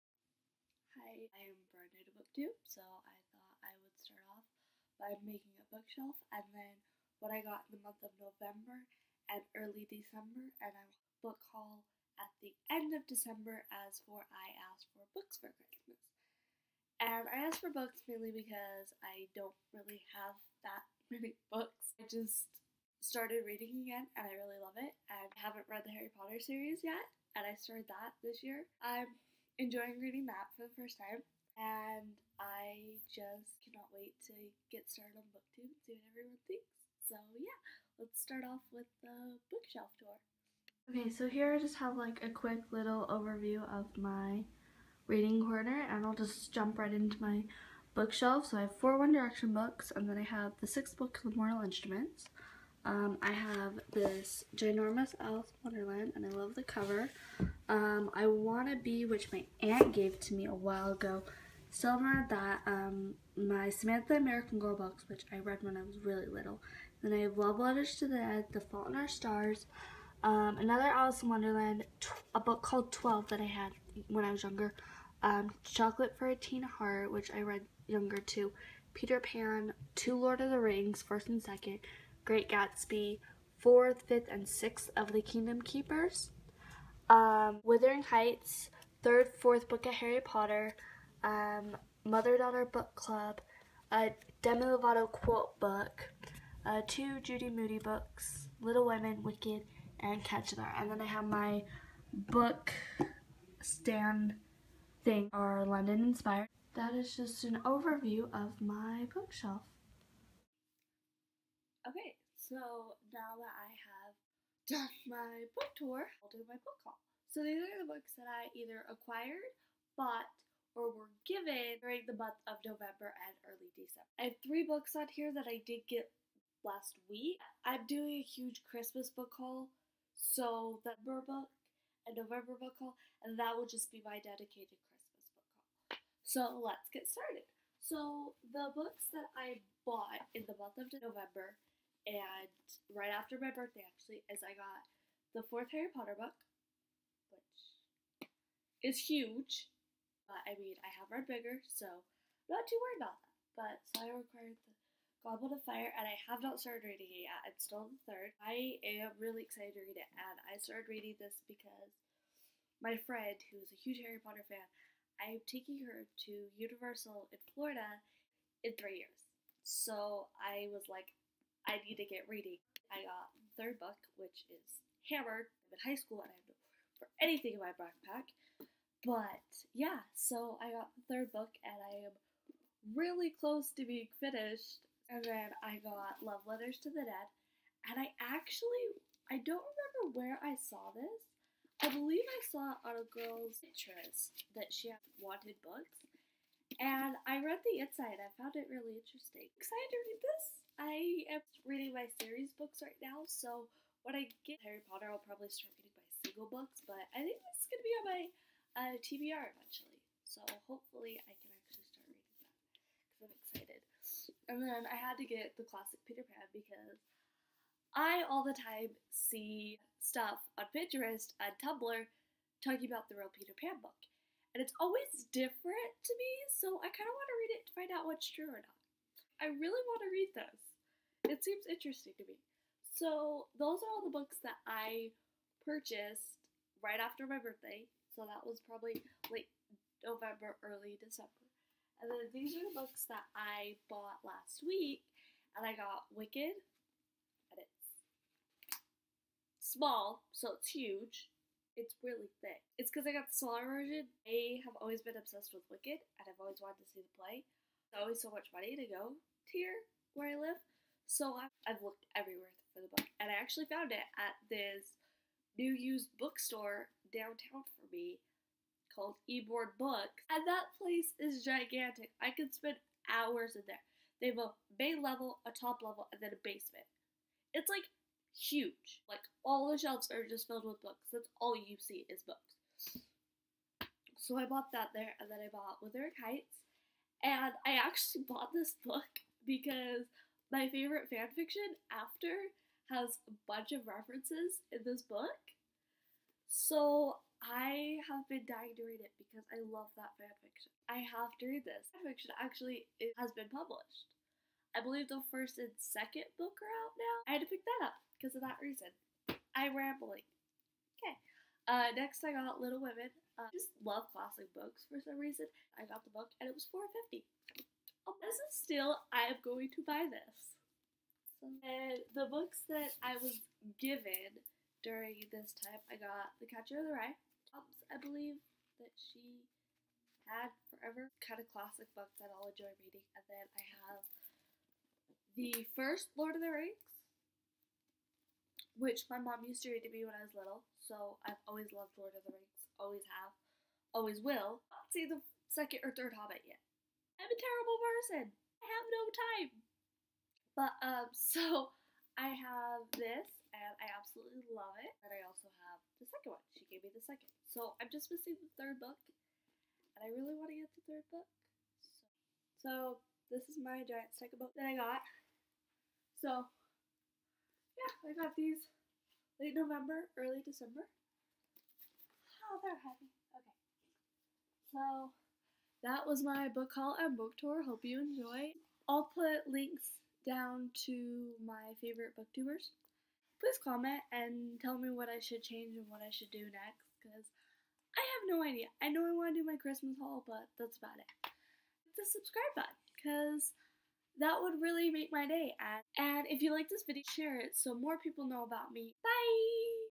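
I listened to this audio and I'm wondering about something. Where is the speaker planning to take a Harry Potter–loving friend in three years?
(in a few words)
Universal in Florida.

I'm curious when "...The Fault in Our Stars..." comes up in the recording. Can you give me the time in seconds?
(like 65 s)
68 s.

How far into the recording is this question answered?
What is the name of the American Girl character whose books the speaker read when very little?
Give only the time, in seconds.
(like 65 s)
63 s.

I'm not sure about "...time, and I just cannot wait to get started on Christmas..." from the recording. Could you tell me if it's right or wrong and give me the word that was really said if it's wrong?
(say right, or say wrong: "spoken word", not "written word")
wrong: "BookTube", not "Christmas".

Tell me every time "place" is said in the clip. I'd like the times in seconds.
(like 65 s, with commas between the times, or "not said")
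270 s.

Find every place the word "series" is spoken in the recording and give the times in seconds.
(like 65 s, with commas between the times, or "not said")
26 s, 202 s.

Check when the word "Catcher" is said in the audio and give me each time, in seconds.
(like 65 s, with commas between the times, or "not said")
100 s, 326 s.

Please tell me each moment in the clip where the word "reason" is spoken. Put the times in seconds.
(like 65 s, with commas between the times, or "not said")
308 s, 315 s.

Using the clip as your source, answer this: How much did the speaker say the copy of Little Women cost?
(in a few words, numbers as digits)
4.50.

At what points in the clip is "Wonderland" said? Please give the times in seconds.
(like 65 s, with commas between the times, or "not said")
55 s, 71 s.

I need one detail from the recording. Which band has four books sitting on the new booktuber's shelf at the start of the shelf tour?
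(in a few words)
One Direction.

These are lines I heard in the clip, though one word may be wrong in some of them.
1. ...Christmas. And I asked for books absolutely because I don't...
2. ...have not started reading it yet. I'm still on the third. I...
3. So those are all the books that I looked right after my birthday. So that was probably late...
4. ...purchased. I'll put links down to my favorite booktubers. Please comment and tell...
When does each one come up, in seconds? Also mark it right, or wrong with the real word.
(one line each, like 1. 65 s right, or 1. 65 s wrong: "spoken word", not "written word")
1. 15 s wrong: "mainly", not "absolutely"
2. 156 s right
3. 232 s wrong: "purchased", not "looked"
4. 377 s wrong: "enjoyed", not "purchased".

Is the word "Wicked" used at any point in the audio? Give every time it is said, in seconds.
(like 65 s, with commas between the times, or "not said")
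99 s, 246 s, 255 s.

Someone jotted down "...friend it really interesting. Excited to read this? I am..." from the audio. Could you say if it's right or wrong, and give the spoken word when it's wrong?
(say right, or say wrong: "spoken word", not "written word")
wrong: "found", not "friend".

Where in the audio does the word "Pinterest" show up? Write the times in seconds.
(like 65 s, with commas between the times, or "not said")
193 s, 220 s.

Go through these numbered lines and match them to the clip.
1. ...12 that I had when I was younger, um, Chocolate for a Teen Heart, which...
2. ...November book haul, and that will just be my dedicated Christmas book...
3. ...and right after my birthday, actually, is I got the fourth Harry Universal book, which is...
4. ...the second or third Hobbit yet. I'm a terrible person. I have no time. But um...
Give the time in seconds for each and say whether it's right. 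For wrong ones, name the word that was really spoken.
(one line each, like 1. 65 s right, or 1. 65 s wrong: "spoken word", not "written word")
1. 72 s right
2. 132 s right
3. 142 s wrong: "Potter", not "Universal"
4. 345 s right.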